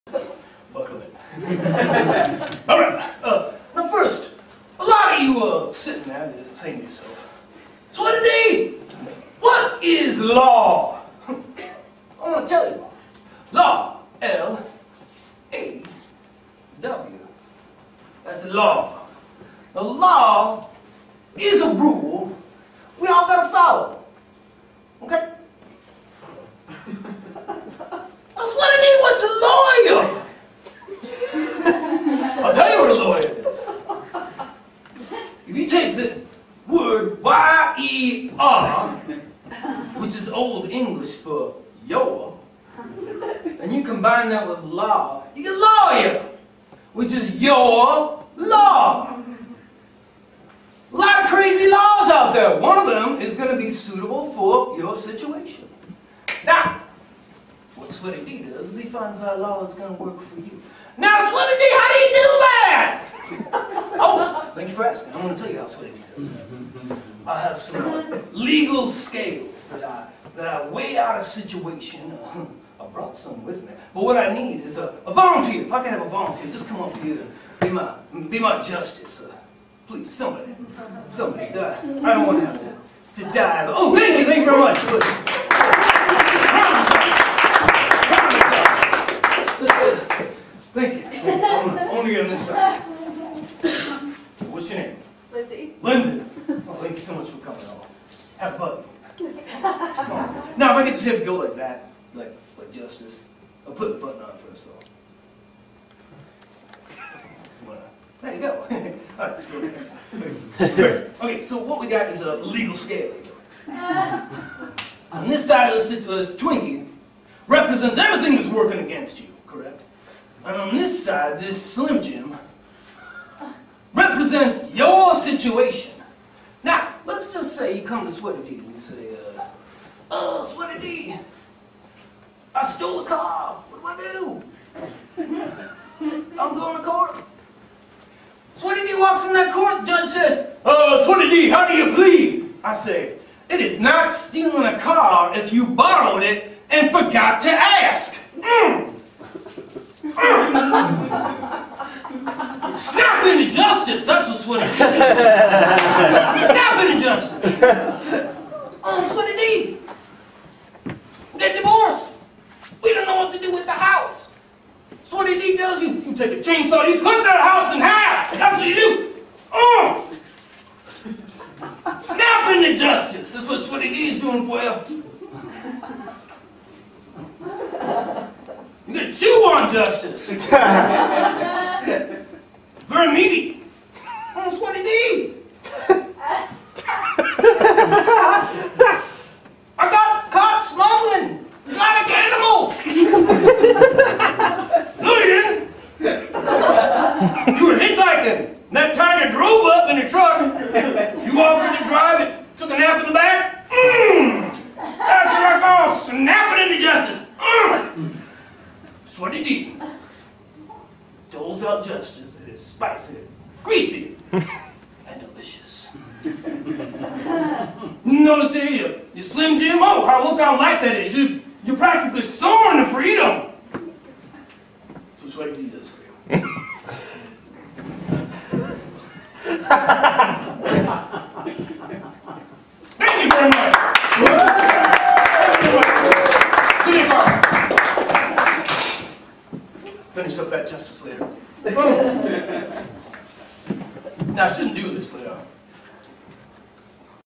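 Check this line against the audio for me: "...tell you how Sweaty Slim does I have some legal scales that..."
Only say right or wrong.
wrong.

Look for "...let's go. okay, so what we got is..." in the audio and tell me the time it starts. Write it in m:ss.
1:49.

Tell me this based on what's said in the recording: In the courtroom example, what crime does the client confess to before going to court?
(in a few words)
Stole a car.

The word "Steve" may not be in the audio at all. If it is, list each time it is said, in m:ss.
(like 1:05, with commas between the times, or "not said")
not said.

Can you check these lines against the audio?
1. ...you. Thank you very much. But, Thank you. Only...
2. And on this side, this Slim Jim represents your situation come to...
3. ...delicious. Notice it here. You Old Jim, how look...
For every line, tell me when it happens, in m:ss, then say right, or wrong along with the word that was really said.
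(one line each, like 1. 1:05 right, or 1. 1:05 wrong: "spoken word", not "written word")
1. 1:24 right
2. 2:00 right
3. 3:35 wrong: "Slim", not "Old".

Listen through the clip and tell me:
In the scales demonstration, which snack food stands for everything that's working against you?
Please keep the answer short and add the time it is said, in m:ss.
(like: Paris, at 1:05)
Twinkie, at 1:56.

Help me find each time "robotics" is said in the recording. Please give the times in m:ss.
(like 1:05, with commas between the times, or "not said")
not said.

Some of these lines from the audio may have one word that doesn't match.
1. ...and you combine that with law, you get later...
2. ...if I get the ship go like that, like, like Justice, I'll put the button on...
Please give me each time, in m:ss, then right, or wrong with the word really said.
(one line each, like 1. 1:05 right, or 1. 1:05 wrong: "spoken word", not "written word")
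1. 0:43 wrong: "lawyer", not "later"
2. 1:40 right.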